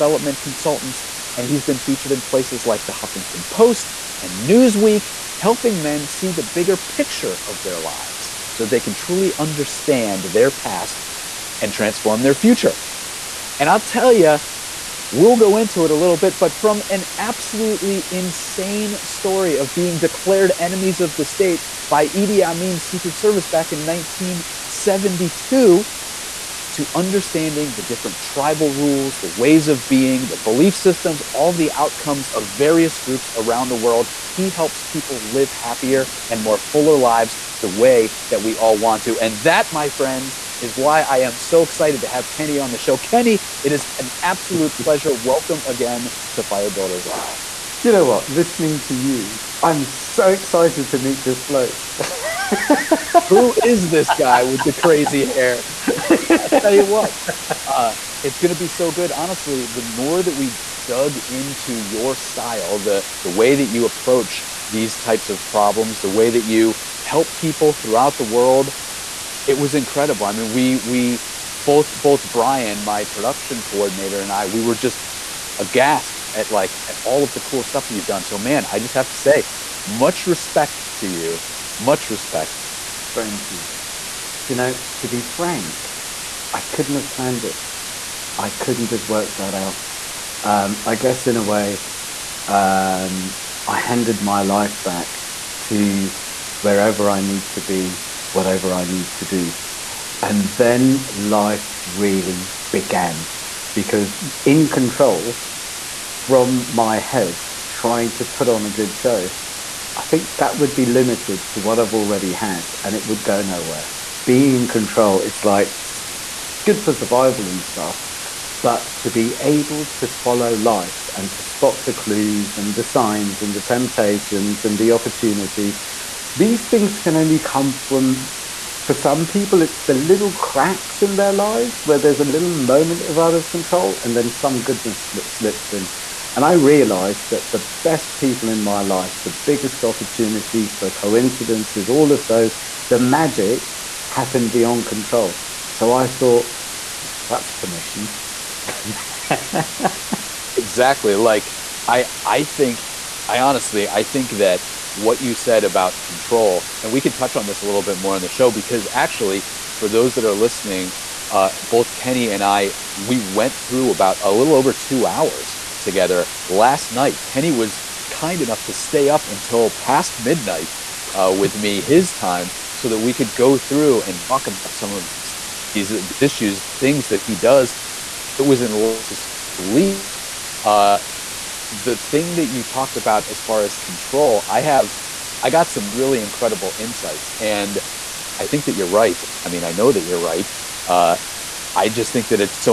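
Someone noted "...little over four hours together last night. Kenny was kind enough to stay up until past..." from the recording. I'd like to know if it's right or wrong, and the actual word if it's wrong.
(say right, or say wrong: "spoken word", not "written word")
wrong: "two", not "four".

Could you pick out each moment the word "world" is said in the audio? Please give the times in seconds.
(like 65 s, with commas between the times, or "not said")
33 s, 68 s.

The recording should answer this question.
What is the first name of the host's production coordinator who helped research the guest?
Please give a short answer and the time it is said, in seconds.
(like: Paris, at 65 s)
Brian, at 72 s.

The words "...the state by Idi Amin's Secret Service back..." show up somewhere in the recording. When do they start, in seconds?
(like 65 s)
21 s.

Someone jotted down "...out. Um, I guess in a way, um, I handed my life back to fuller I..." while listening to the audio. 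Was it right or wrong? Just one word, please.
wrong.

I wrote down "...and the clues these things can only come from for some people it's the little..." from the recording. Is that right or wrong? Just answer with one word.
wrong.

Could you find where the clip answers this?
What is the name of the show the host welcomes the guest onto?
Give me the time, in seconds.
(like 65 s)
46 s.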